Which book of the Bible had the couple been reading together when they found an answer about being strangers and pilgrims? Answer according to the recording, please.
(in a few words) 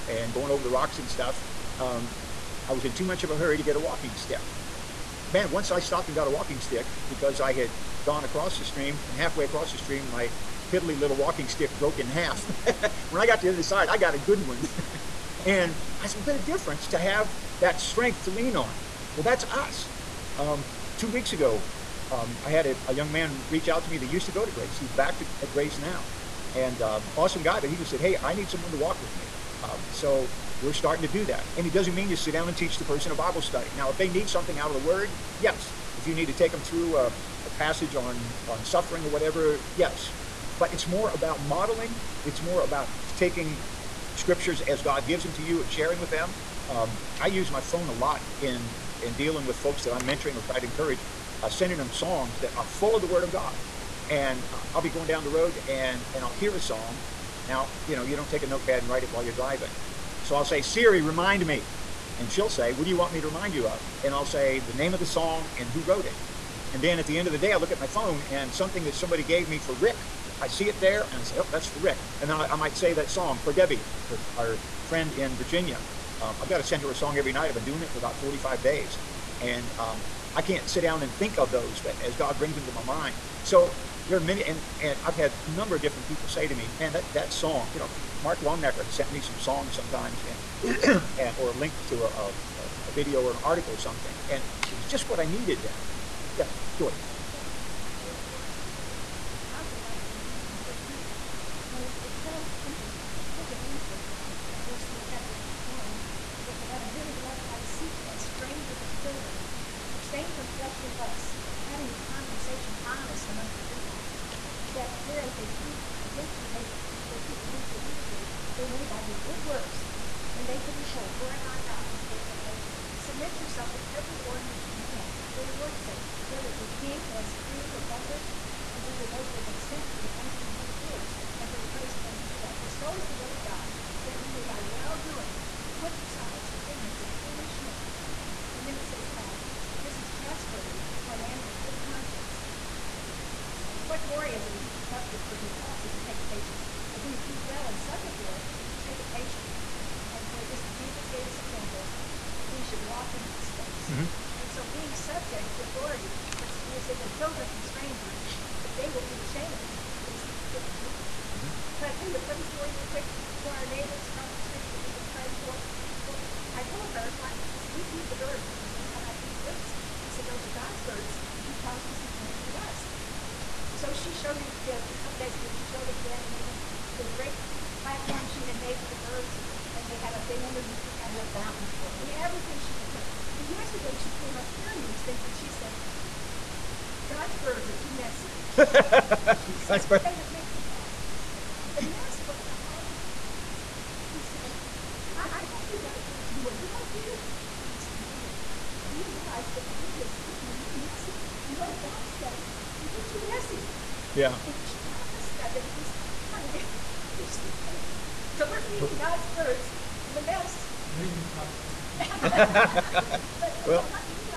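First Peter.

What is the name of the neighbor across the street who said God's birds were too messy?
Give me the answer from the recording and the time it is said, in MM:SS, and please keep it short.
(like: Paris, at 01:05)
Megan, at 03:17.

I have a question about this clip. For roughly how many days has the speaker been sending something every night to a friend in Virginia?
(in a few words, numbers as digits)
45.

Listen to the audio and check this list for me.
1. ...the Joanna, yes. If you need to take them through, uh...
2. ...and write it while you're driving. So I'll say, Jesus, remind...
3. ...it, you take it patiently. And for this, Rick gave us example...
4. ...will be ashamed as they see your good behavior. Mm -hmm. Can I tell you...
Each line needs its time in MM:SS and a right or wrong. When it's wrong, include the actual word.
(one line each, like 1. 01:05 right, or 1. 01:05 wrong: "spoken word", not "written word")
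1. 00:34 wrong: "Word", not "Joanna"
2. 00:58 wrong: "Siri", not "Jesus"
3. 02:28 wrong: "Jesus", not "Rick"
4. 02:38 right.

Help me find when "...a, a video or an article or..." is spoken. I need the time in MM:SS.
01:32.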